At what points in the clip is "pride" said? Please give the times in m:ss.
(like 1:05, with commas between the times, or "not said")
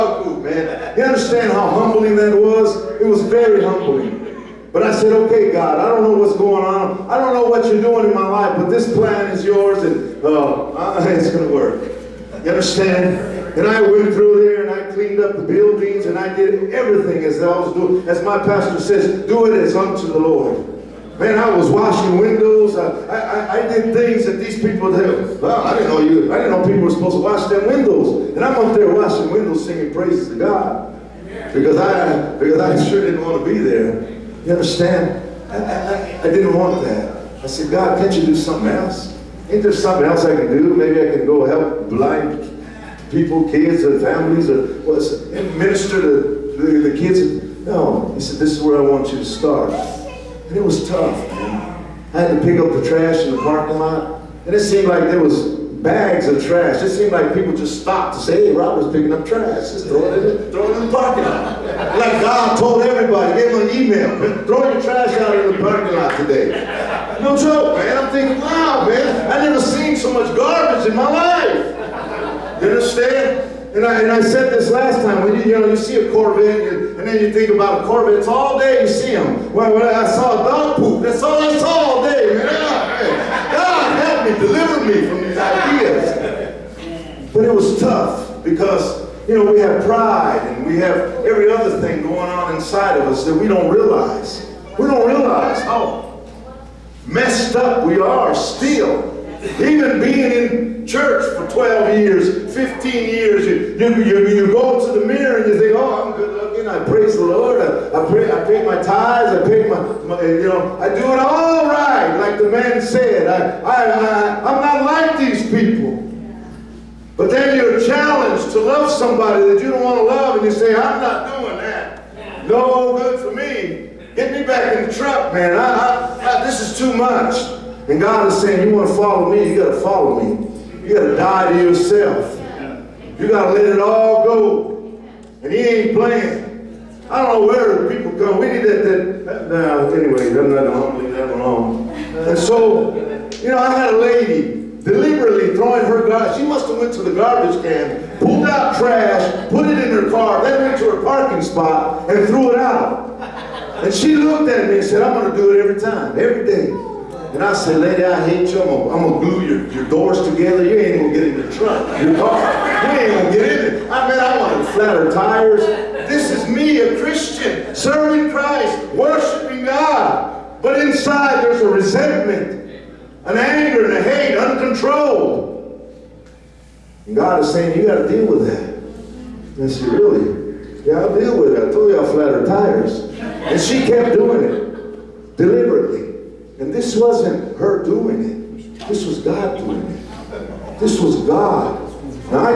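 1:29.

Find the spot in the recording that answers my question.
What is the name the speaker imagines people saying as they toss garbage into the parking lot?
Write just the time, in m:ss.
0:58.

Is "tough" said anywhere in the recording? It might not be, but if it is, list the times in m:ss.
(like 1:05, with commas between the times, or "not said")
0:50, 1:27.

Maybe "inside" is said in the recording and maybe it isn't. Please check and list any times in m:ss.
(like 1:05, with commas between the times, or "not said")
1:32, 2:50.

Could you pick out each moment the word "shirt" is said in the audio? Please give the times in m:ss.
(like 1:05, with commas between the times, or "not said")
not said.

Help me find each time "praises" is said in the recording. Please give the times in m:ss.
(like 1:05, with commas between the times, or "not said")
0:29, 1:46.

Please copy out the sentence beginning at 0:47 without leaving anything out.
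No, he said, this is where I want you to start.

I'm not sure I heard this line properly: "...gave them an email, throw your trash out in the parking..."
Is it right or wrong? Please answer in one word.
right.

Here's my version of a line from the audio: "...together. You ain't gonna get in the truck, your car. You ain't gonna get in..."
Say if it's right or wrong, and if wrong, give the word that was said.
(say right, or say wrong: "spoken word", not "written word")
right.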